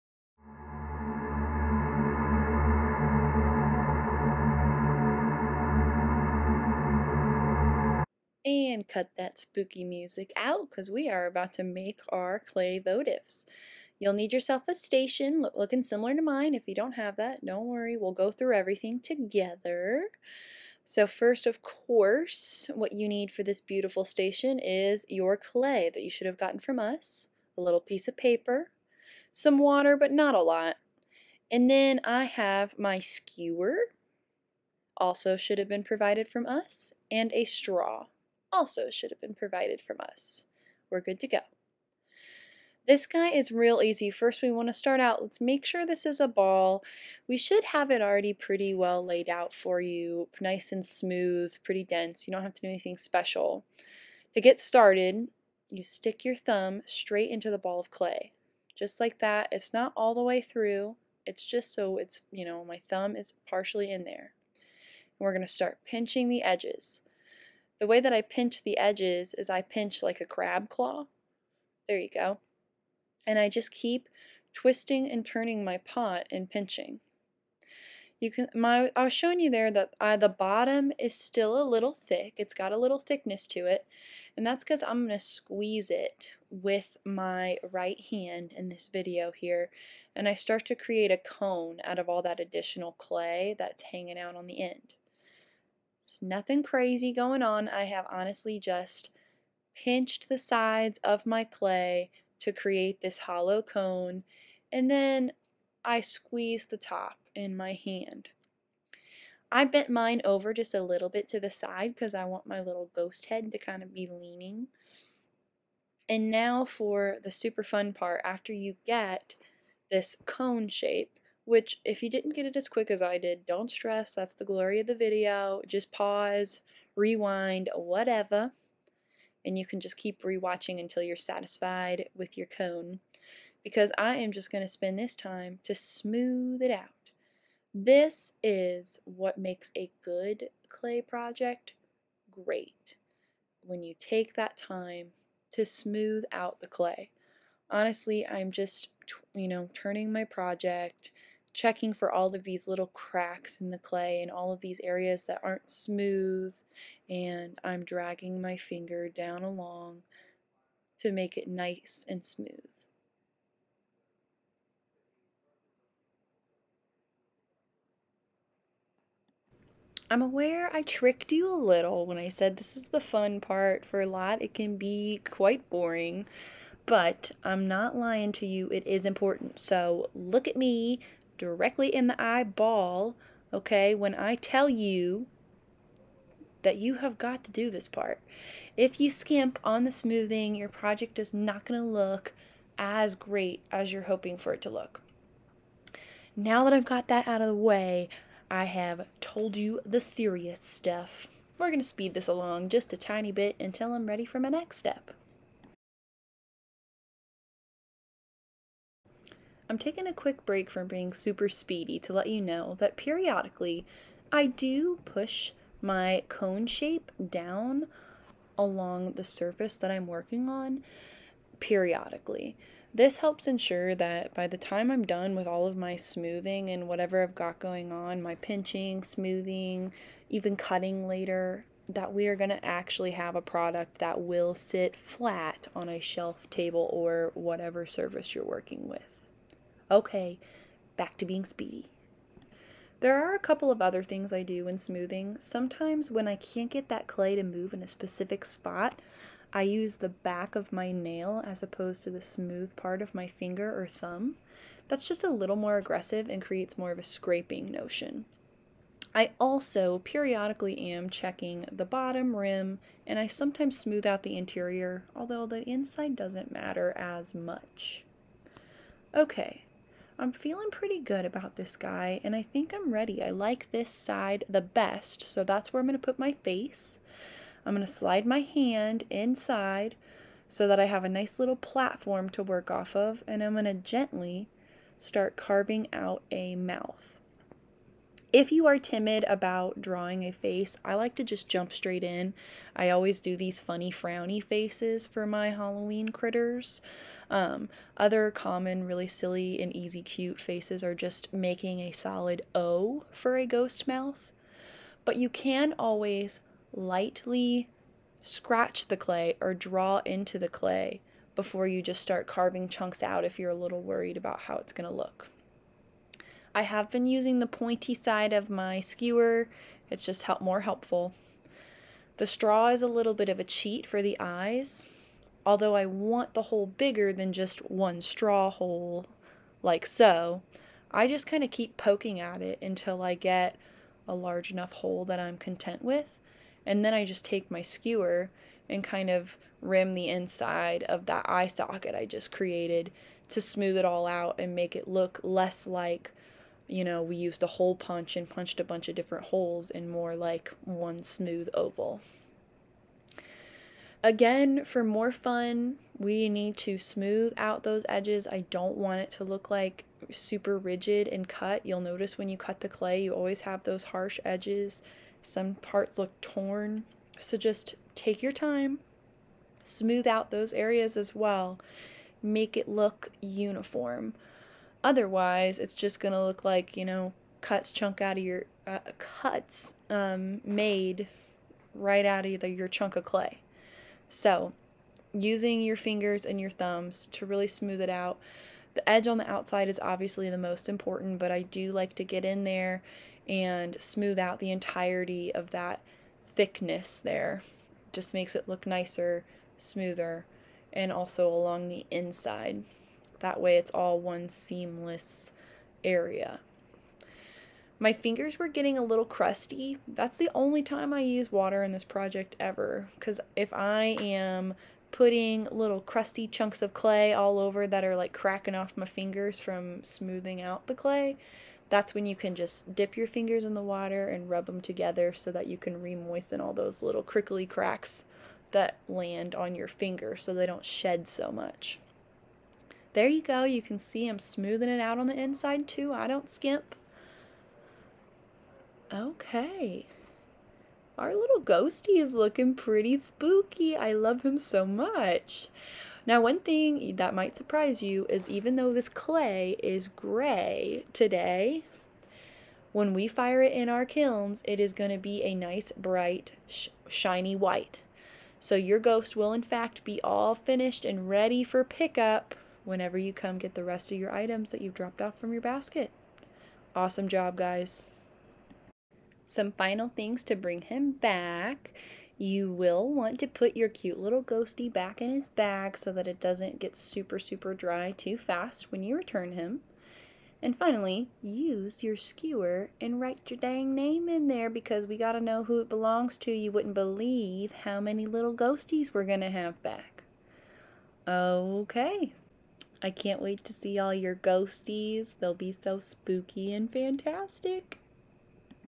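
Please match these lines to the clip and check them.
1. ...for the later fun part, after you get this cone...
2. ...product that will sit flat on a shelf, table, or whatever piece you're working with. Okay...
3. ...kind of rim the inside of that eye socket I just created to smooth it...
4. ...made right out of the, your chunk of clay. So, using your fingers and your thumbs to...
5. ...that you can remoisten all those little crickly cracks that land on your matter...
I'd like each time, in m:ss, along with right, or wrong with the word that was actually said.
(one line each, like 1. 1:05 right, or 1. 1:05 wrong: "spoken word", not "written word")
1. 1:56 wrong: "super", not "later"
2. 3:53 wrong: "surface", not "piece"
3. 5:38 right
4. 6:20 right
5. 7:05 wrong: "finger", not "matter".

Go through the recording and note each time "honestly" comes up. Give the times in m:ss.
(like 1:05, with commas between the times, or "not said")
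1:38, 2:27.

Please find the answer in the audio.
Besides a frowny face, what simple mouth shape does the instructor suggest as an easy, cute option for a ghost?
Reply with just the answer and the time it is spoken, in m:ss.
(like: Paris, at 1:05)
a solid O, at 5:01.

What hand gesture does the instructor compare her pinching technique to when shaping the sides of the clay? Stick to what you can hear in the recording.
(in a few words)
crab claw.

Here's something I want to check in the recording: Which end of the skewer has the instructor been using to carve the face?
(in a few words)
the pointy side.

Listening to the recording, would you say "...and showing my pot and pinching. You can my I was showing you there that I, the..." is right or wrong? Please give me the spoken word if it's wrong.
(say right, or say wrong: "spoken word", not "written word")
wrong: "turning", not "showing".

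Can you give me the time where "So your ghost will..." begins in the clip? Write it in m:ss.
7:38.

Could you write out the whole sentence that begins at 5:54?
Again, for more fun, we need to smooth out those edges.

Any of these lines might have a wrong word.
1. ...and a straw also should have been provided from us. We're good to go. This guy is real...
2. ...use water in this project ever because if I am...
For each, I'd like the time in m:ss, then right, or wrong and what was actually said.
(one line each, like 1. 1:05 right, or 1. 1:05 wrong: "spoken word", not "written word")
1. 0:37 right
2. 6:51 right.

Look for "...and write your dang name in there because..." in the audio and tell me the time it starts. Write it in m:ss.
8:02.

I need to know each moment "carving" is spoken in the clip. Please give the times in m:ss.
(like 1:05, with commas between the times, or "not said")
4:45, 5:12.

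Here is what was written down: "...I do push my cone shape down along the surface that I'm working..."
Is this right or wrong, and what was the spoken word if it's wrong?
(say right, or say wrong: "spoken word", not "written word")
right.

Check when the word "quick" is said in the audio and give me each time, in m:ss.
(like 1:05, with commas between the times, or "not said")
2:02, 3:30.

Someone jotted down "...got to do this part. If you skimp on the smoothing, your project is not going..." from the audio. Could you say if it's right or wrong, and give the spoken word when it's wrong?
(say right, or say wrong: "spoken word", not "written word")
right.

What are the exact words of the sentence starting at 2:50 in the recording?
I'm aware I tricked you a little when I said this is the fun part.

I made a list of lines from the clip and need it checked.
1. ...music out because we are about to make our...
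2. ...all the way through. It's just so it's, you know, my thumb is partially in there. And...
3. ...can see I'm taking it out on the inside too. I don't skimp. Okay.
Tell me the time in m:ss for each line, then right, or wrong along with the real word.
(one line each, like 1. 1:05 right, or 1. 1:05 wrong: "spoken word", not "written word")
1. 0:09 right
2. 0:59 right
3. 7:13 wrong: "smoothing", not "taking".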